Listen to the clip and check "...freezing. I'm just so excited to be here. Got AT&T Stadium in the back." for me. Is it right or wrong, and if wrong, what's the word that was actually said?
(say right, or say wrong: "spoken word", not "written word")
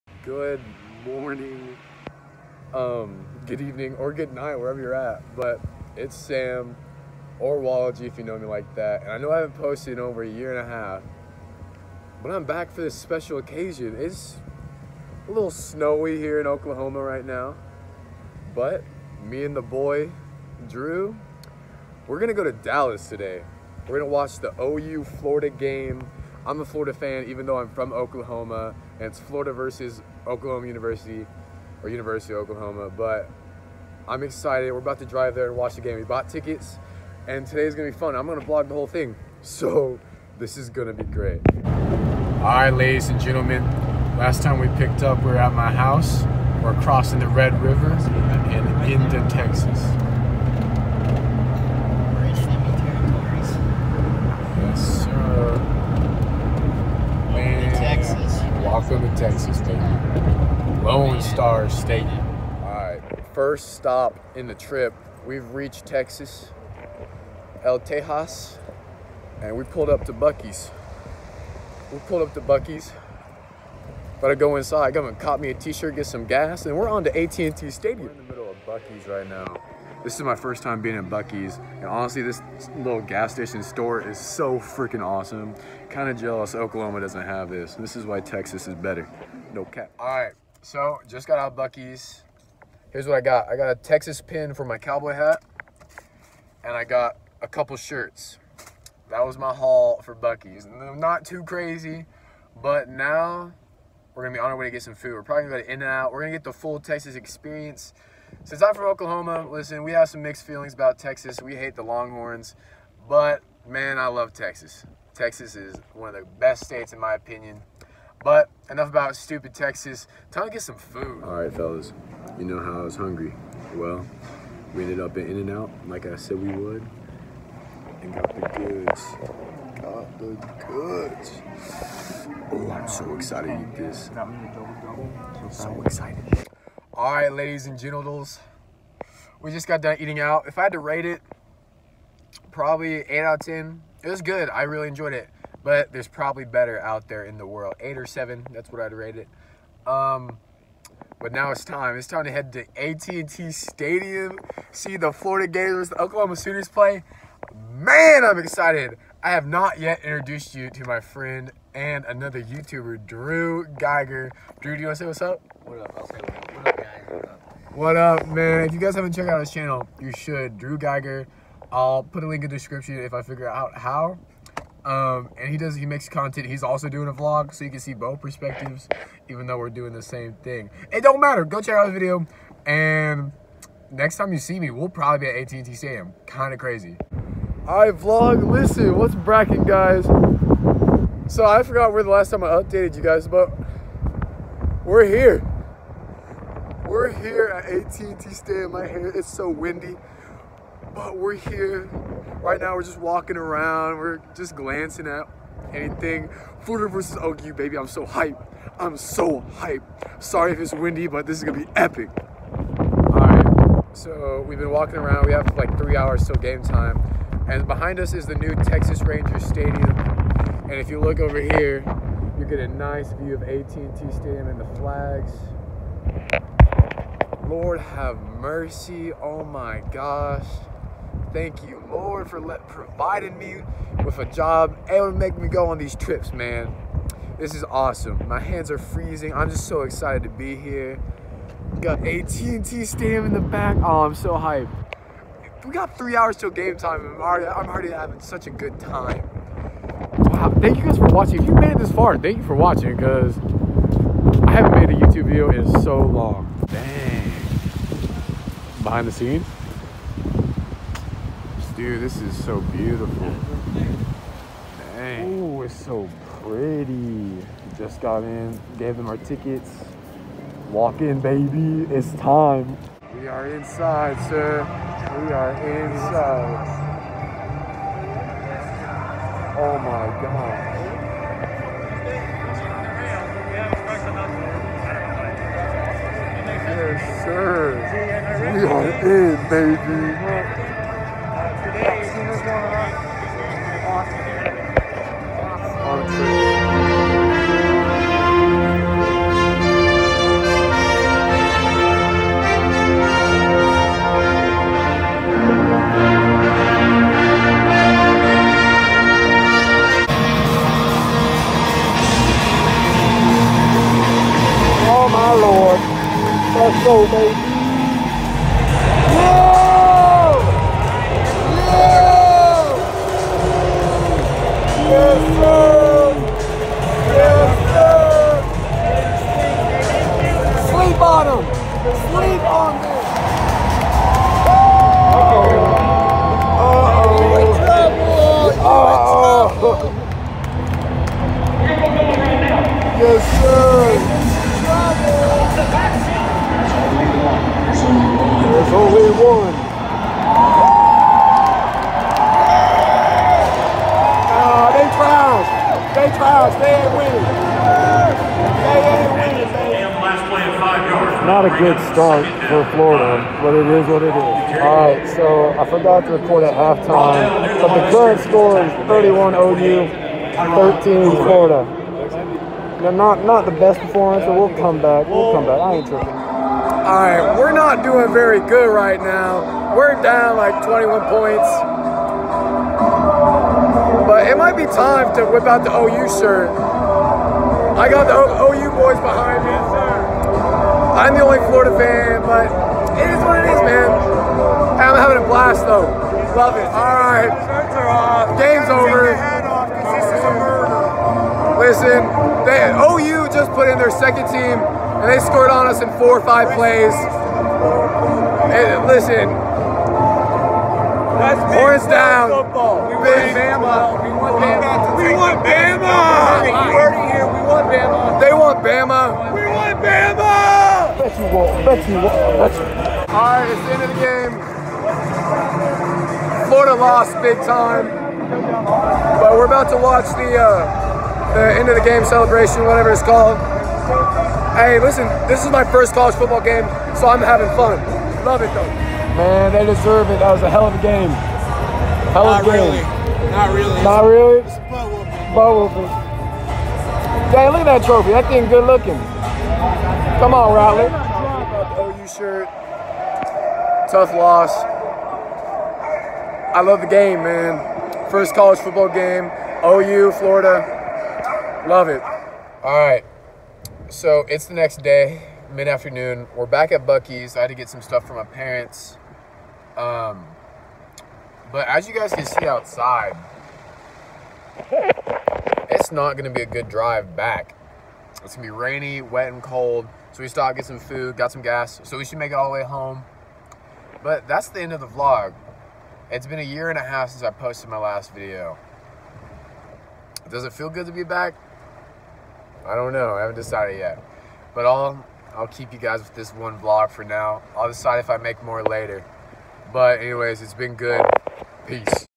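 right.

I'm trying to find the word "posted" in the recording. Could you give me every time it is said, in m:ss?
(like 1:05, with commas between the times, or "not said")
0:09, 8:07.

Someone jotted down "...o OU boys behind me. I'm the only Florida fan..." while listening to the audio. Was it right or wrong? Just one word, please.
right.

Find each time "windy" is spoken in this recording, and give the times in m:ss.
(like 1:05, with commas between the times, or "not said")
3:19, 3:30.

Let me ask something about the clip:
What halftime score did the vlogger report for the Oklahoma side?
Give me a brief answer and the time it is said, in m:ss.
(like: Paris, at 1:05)
31, at 6:08.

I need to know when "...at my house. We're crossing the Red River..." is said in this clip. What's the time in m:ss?
0:45.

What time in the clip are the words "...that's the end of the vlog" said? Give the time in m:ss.
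8:04.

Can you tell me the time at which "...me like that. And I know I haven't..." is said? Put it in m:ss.
0:08.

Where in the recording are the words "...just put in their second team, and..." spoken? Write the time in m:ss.
6:43.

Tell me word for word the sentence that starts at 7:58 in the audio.
It's going to be rainy, wet, and cold.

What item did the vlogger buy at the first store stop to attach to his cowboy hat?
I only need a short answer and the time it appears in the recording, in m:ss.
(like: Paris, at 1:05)
A Texas pin, at 1:33.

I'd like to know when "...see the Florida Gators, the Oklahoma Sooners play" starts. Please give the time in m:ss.
2:34.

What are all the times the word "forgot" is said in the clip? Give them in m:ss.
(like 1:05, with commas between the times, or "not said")
3:11, 6:05.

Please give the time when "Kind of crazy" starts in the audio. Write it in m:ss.
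3:06.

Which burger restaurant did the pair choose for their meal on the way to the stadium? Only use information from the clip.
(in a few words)
In-N-Out.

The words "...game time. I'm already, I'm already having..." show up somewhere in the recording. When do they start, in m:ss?
4:06.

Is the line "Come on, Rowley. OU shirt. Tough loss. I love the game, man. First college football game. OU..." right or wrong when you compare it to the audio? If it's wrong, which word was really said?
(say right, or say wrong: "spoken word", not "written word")
right.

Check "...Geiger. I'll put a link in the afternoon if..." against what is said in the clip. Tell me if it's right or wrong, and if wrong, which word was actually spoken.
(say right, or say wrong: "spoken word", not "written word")
wrong: "description", not "afternoon".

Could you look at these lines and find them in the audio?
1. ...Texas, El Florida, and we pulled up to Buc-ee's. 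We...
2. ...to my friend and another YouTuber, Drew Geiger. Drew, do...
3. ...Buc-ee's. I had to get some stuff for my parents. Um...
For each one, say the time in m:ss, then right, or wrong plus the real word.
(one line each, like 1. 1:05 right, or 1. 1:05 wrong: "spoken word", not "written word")
1. 1:05 wrong: "Tejas", not "Florida"
2. 2:40 right
3. 7:46 right.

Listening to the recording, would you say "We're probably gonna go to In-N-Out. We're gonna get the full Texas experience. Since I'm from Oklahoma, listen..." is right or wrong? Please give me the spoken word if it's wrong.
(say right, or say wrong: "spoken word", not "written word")
right.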